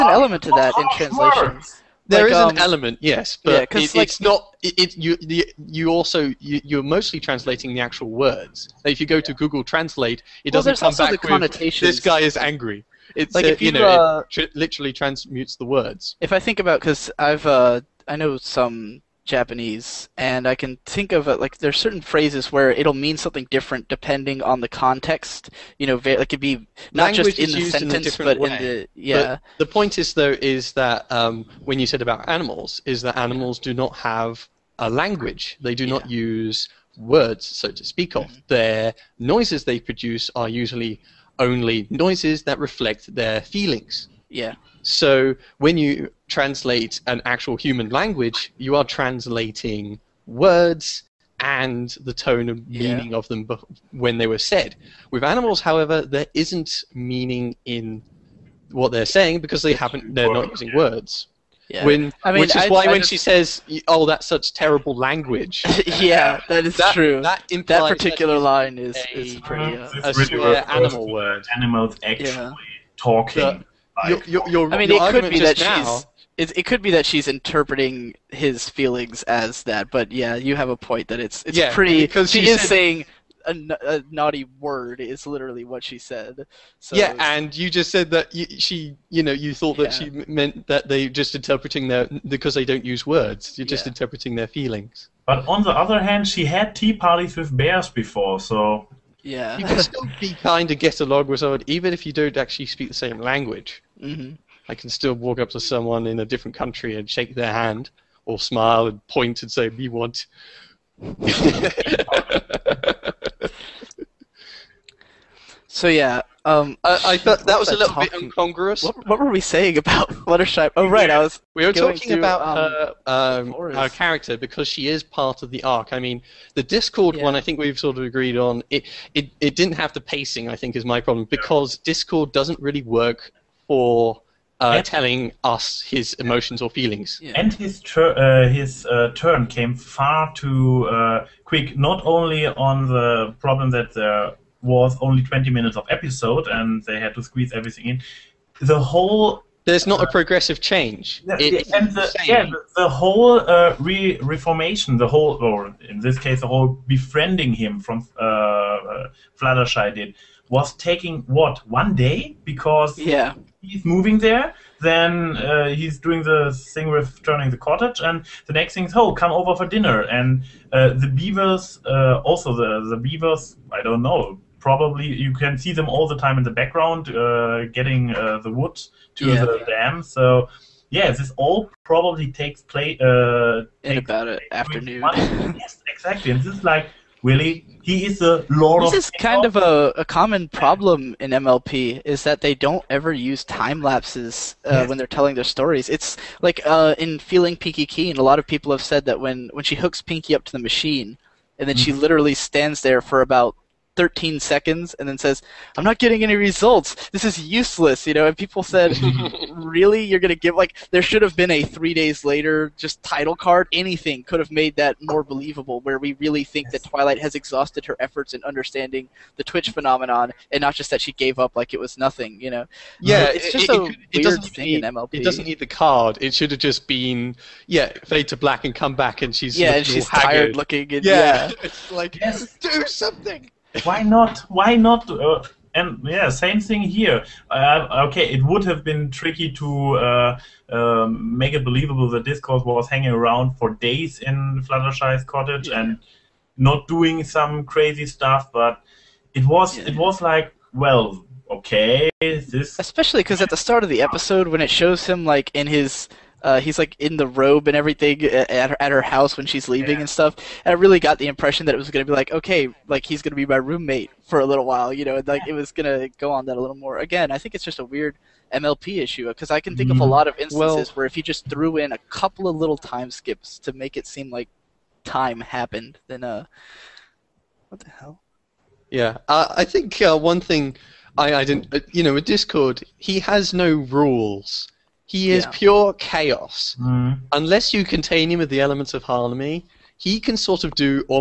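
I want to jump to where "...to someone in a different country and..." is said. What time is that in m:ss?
1:45.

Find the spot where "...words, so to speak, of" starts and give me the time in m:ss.
0:36.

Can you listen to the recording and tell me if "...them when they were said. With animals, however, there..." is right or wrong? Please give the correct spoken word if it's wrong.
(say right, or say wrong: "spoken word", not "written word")
right.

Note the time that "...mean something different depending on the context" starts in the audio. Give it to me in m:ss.
0:22.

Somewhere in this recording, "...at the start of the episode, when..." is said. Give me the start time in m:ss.
4:13.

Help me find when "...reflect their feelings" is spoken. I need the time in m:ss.
0:42.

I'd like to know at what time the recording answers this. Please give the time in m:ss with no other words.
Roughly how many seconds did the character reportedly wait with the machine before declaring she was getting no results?
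3:23.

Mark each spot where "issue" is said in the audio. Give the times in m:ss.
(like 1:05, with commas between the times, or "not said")
4:29.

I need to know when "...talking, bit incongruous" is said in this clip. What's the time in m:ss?
1:57.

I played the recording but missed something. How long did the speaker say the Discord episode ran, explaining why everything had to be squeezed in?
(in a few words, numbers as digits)
20 minutes.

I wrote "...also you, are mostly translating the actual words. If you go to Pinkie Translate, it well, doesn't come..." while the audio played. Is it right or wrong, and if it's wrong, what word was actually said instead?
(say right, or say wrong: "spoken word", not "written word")
wrong: "Google", not "Pinkie".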